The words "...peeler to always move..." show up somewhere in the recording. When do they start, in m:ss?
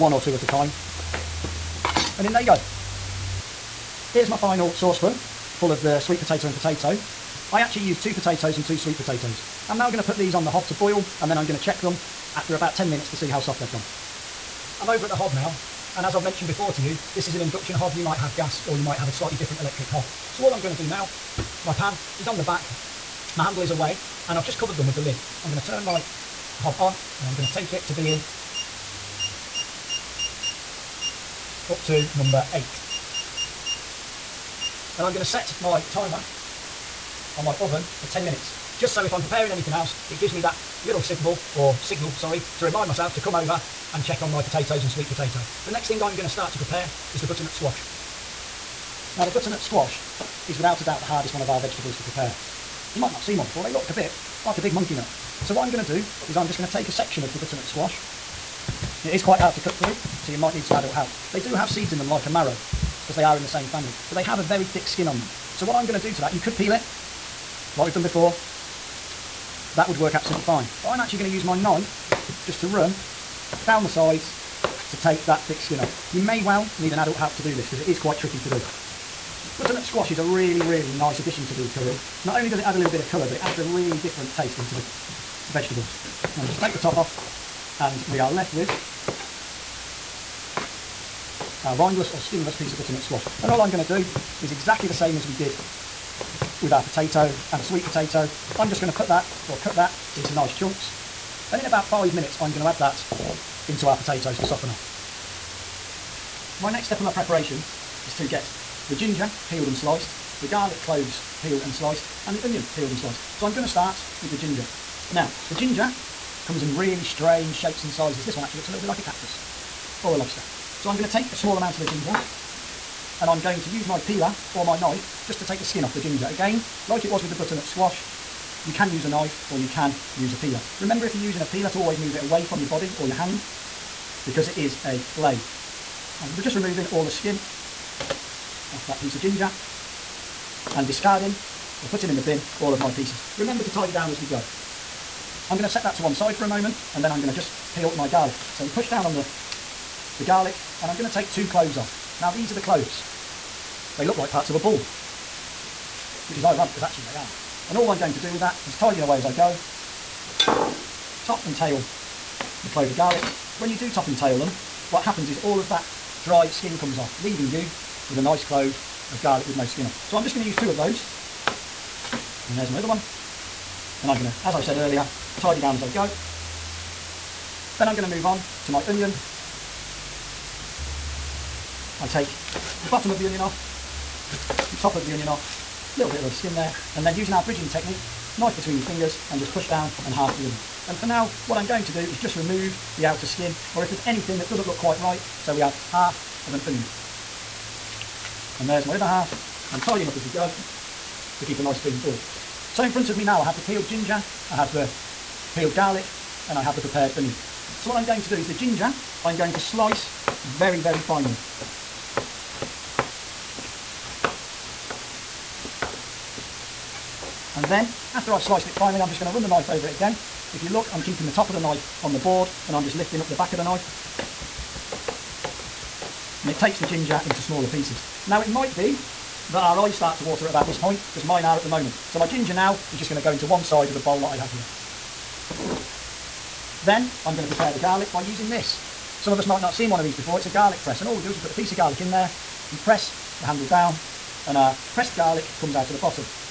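2:11.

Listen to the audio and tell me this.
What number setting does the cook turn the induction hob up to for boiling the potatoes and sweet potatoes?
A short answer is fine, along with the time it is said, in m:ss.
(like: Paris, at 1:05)
8, at 0:32.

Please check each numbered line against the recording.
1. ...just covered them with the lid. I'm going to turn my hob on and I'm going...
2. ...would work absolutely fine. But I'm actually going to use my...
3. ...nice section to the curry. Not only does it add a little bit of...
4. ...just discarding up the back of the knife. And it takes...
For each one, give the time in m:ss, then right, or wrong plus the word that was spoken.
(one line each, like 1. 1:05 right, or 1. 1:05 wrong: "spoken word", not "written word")
1. 0:24 right
2. 1:09 right
3. 1:20 wrong: "addition", not "section"
4. 3:42 wrong: "lifting", not "discarding".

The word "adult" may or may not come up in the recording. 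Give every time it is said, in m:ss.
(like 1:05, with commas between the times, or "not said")
1:00, 1:16.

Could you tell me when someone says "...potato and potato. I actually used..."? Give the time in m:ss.
0:06.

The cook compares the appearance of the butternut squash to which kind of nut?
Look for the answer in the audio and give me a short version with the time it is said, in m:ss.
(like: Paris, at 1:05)
Monkey nut, at 0:54.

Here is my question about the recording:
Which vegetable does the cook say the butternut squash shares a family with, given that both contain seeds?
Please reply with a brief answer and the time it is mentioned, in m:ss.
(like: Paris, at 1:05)
Marrow, at 1:02.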